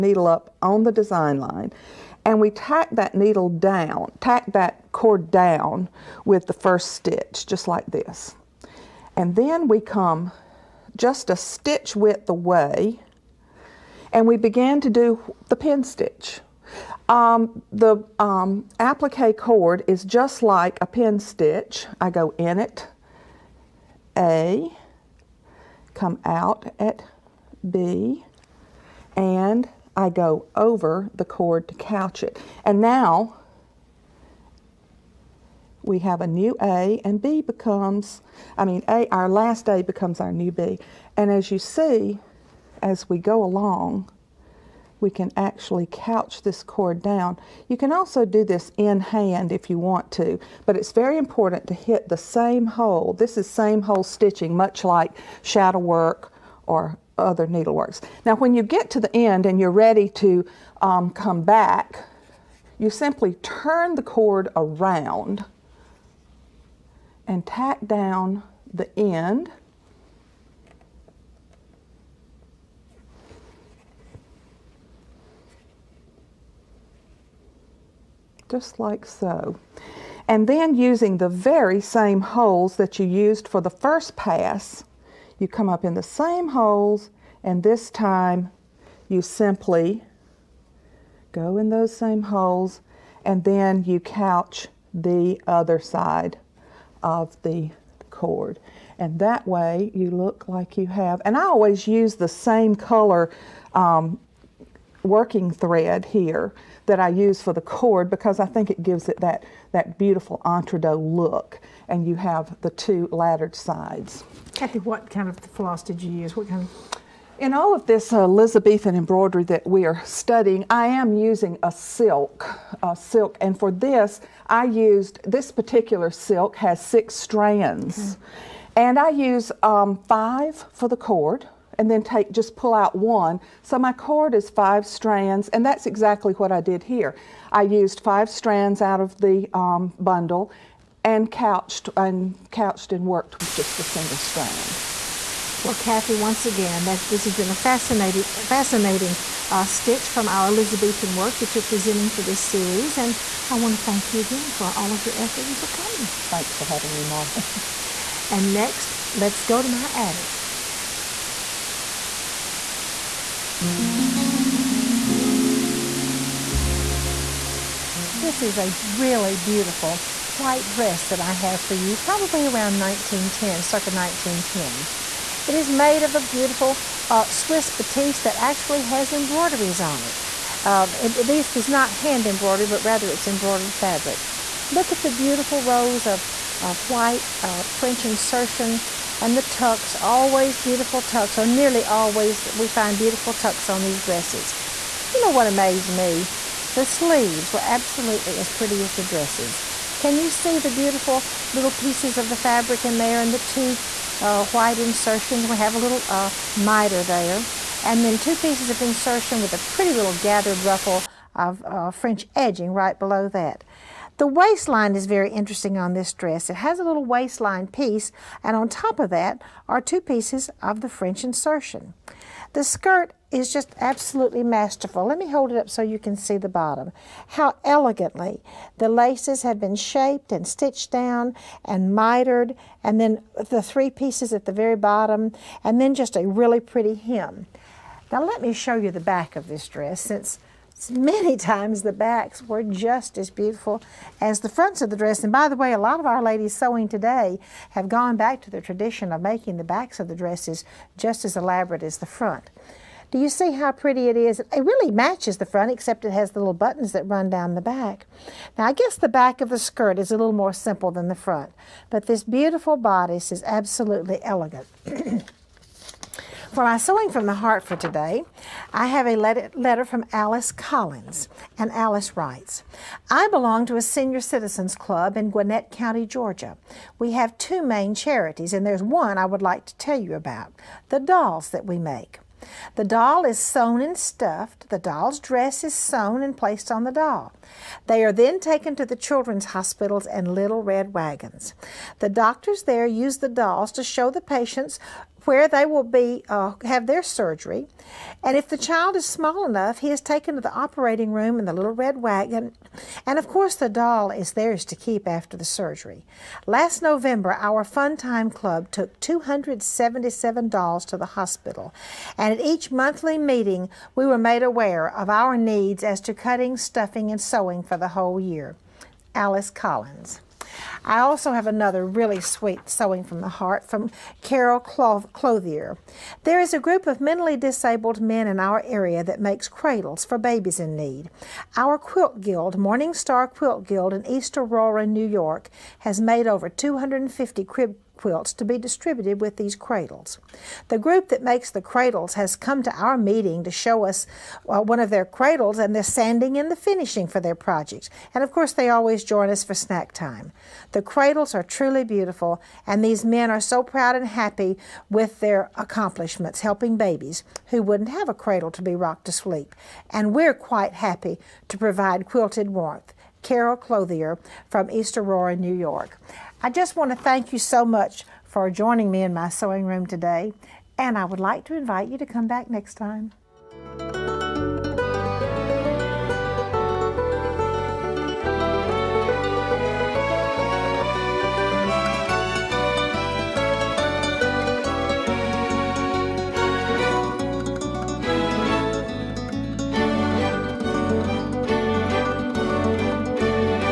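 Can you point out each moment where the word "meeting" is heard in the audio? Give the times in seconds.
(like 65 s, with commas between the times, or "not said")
313 s, 342 s.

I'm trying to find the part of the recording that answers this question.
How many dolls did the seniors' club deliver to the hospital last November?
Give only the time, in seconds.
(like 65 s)
308 s.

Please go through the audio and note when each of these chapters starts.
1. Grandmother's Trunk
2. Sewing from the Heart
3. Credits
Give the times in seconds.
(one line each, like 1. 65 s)
1. 163 s
2. 266 s
3. 373 s.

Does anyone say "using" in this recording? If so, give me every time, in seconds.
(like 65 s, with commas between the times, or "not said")
80 s, 121 s.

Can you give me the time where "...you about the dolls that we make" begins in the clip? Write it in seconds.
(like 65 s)
280 s.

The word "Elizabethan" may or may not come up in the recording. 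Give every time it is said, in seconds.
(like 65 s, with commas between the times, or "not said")
118 s, 150 s.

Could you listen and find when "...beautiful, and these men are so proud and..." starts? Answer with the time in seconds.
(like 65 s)
351 s.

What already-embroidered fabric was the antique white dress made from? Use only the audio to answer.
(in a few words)
Swiss batiste.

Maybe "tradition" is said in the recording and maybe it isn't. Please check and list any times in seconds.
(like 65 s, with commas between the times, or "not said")
248 s.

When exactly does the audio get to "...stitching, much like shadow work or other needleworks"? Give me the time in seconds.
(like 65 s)
54 s.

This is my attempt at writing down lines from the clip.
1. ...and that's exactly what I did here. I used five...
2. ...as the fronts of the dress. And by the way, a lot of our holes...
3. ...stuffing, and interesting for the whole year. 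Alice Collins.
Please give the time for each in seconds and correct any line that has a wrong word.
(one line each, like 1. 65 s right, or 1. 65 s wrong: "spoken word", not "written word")
1. 135 s right
2. 244 s wrong: "ladies", not "holes"
3. 316 s wrong: "sewing", not "interesting".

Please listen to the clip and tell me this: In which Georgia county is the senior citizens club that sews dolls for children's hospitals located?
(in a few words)
Gwinnett County.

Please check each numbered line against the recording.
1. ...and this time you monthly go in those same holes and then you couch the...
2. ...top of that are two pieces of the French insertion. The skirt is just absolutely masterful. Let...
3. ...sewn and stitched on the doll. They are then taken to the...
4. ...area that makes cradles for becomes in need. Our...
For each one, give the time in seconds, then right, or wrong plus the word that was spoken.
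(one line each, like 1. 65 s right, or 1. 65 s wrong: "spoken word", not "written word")
1. 87 s wrong: "simply", not "monthly"
2. 218 s right
3. 285 s wrong: "placed", not "stitched"
4. 328 s wrong: "babies", not "becomes".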